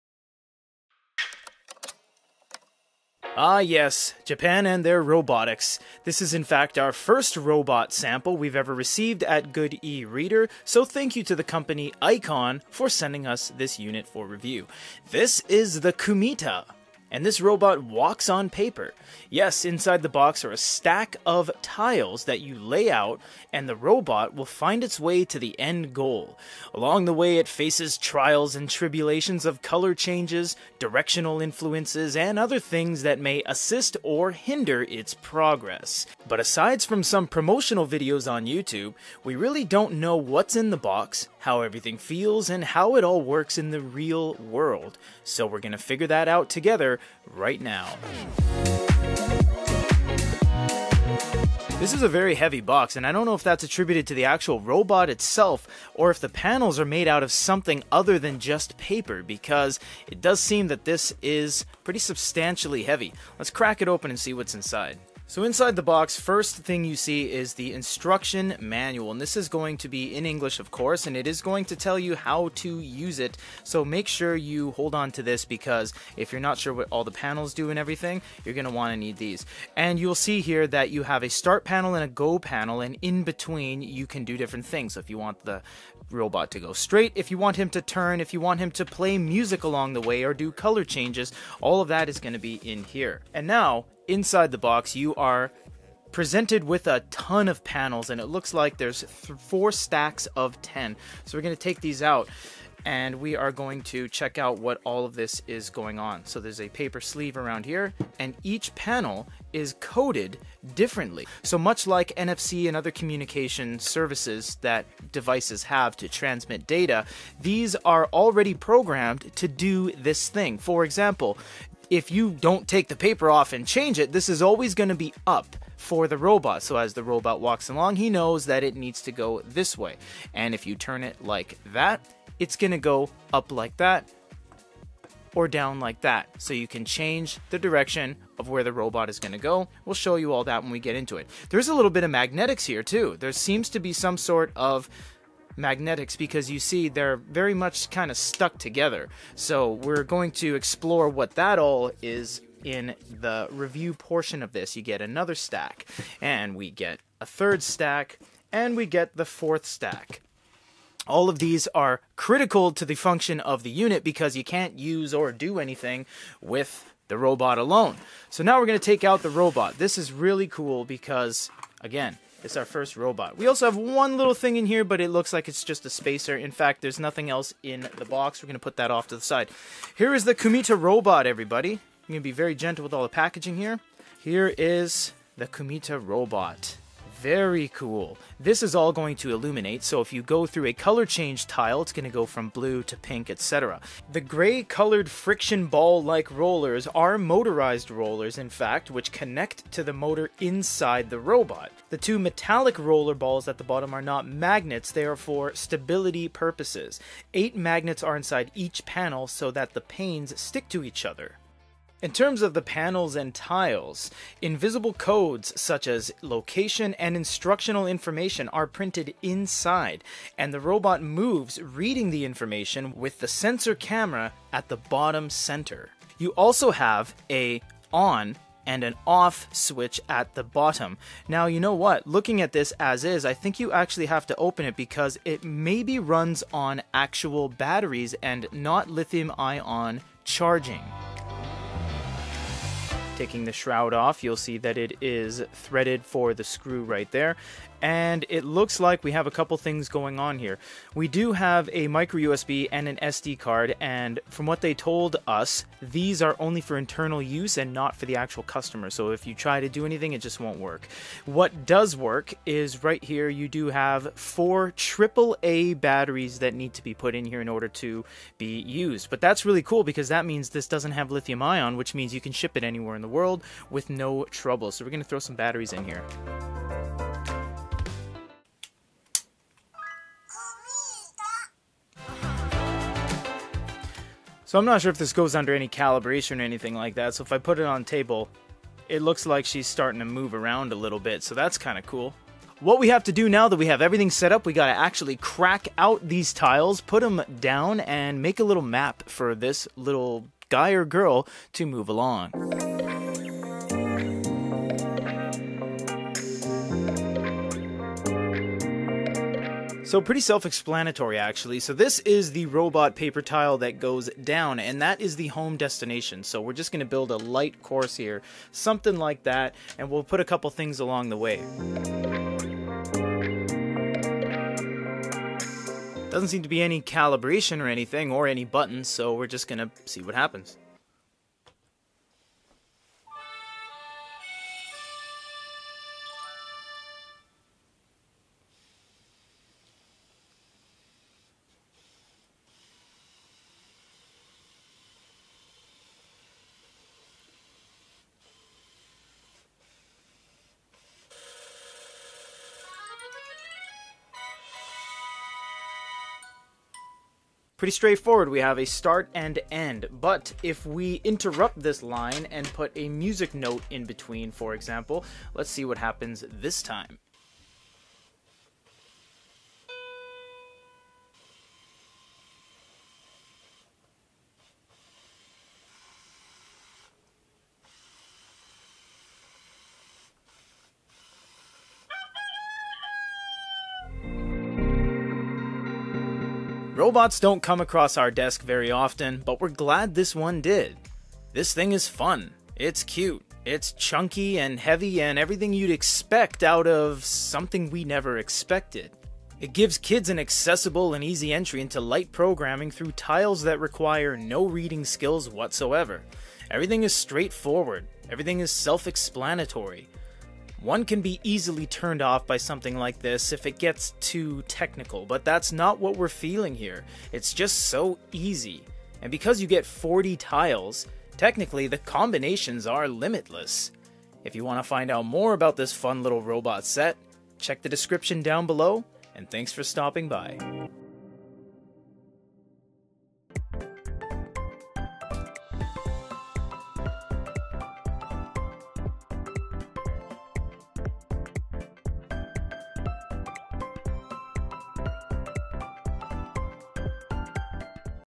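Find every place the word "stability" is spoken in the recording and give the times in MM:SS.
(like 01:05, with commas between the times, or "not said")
03:25.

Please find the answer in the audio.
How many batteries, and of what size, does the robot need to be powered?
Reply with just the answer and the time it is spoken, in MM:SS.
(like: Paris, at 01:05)
4 AAA, at 04:24.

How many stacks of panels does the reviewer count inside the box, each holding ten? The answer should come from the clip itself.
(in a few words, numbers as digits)
4.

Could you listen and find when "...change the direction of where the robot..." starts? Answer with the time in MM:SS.
02:16.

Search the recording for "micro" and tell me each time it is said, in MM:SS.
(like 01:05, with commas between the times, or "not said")
04:11.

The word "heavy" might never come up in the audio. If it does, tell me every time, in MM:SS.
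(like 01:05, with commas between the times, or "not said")
00:52, 01:02, 06:34.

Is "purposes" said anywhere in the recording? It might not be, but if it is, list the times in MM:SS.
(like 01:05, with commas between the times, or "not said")
03:26.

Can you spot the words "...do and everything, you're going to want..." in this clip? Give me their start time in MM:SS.
01:17.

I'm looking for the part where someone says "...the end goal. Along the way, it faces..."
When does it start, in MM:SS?
00:25.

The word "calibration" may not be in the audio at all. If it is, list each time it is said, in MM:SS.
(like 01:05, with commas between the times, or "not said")
04:45, 05:26.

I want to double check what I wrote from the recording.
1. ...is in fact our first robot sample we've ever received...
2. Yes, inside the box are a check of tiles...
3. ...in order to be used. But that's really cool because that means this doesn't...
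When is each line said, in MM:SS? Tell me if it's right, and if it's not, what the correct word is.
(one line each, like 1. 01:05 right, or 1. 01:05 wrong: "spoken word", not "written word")
1. 00:06 right
2. 00:19 wrong: "stack", not "check"
3. 04:27 right.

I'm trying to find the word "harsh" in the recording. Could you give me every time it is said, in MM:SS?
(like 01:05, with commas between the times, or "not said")
not said.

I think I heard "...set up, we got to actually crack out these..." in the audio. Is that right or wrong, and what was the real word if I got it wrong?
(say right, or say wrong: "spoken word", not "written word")
right.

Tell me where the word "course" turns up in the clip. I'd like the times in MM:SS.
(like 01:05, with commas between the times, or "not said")
01:10, 05:17.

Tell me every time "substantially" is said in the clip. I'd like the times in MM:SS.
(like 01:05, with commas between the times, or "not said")
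01:01.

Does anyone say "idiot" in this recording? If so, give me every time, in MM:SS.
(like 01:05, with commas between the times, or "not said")
not said.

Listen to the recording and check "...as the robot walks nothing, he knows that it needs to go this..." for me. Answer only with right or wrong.
wrong.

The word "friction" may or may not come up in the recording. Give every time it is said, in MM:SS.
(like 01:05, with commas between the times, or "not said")
03:15.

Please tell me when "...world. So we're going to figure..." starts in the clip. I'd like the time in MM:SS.
00:44.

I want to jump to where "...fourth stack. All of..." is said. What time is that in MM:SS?
02:39.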